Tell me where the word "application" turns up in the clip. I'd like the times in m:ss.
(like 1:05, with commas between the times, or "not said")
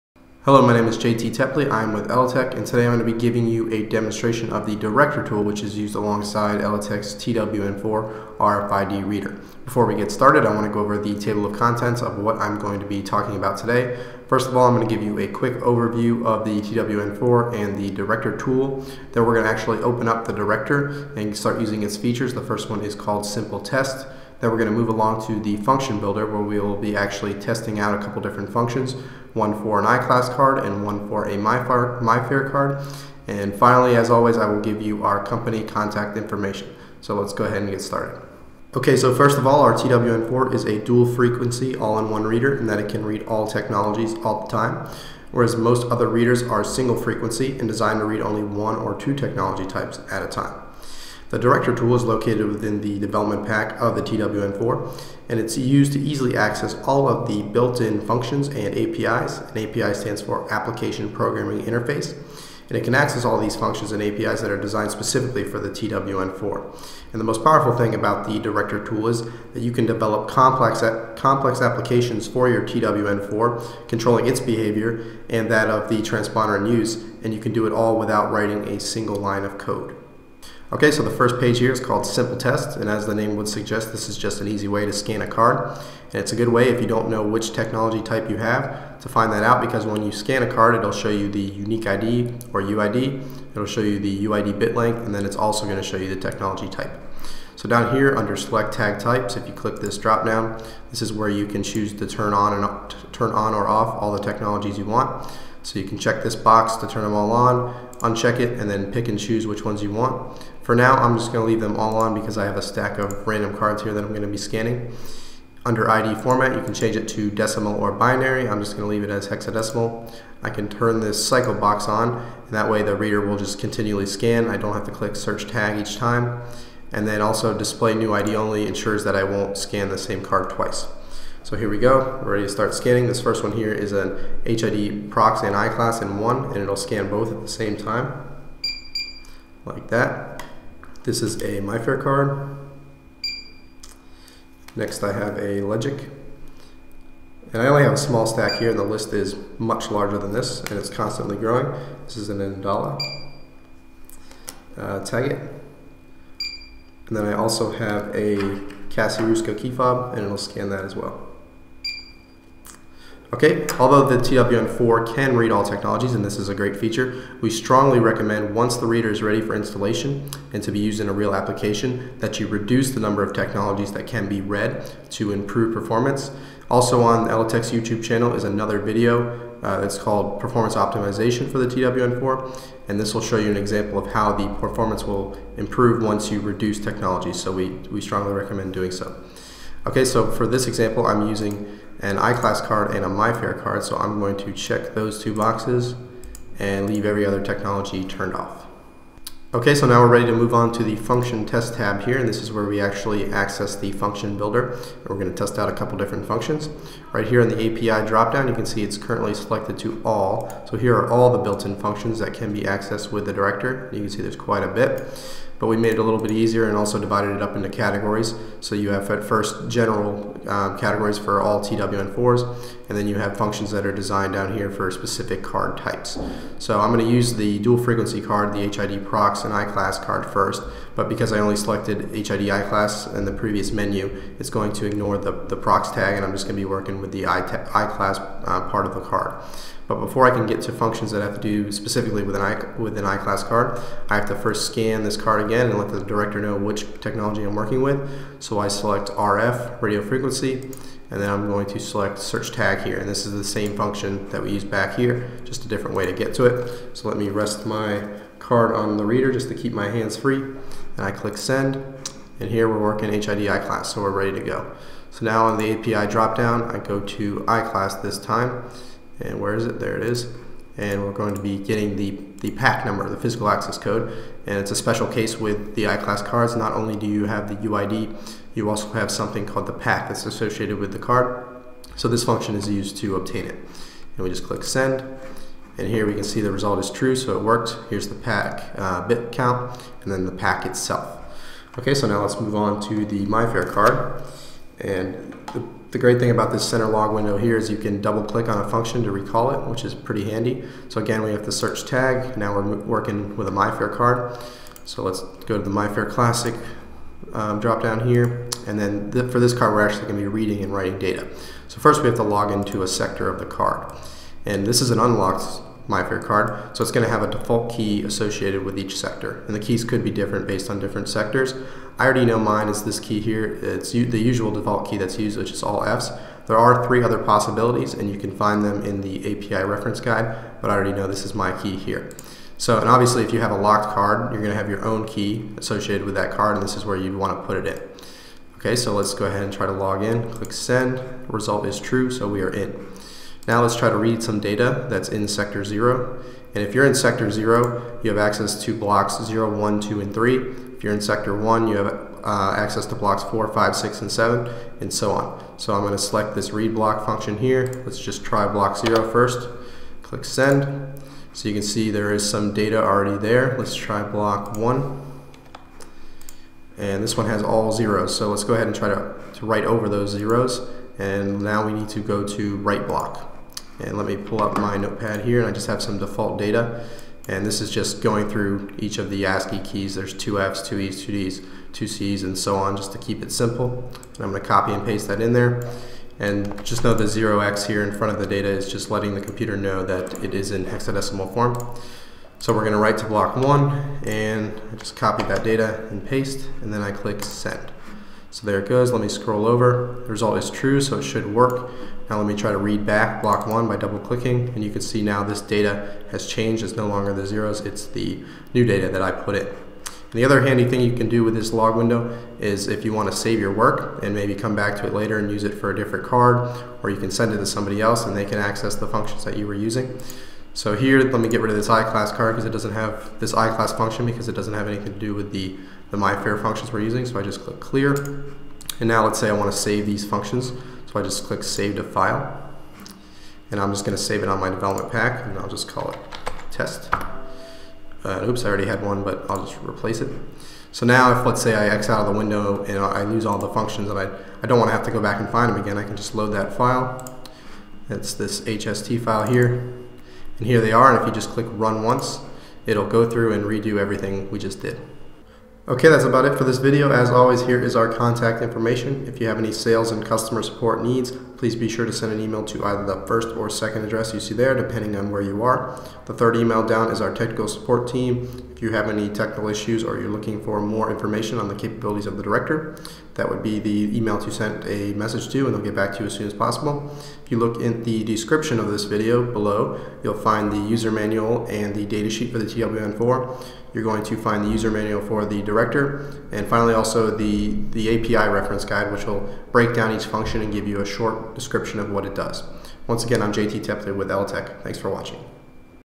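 1:00, 1:11, 2:51.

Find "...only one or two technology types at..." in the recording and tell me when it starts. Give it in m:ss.
0:48.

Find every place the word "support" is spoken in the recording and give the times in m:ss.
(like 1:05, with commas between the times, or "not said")
7:40, 7:47.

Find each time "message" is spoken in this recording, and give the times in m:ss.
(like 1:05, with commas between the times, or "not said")
7:54.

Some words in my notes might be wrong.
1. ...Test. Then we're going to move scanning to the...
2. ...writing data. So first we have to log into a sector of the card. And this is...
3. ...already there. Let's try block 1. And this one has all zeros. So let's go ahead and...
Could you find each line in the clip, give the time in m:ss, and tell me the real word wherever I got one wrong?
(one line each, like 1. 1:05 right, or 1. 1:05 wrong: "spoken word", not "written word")
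1. 0:23 wrong: "along", not "scanning"
2. 5:10 right
3. 6:02 right.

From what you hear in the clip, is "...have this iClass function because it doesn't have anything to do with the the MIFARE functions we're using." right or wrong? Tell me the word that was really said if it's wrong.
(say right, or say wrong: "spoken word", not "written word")
right.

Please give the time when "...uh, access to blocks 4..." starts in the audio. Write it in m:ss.
5:52.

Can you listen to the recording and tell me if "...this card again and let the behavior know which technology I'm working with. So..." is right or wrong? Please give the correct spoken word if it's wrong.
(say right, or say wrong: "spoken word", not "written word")
wrong: "director", not "behavior".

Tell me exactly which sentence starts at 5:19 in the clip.
And the keys could be different based on different sectors.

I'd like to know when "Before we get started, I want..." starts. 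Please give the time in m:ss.
0:09.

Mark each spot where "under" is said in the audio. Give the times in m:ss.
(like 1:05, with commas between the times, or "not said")
1:38, 1:55.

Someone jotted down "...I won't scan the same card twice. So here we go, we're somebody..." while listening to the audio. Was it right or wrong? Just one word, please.
wrong.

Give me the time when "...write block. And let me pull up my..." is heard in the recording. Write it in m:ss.
6:12.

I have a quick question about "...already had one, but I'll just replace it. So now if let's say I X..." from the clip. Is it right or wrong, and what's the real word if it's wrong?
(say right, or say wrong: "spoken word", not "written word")
right.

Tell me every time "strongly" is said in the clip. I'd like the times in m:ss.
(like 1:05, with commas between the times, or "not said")
2:47, 3:08.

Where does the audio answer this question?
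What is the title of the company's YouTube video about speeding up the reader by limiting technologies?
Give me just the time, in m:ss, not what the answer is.
3:00.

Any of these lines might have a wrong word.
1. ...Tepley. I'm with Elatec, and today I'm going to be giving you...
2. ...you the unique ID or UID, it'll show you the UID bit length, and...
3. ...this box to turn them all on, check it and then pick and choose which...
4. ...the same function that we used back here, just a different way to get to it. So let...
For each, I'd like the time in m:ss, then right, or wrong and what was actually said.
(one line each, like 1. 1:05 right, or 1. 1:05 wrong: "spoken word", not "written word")
1. 0:01 right
2. 1:31 right
3. 1:46 wrong: "uncheck", not "check"
4. 4:13 right.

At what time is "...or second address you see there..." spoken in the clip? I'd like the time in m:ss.
7:43.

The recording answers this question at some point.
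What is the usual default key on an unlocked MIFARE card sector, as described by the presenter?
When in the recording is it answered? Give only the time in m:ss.
5:25.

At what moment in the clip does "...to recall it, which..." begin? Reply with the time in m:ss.
4:59.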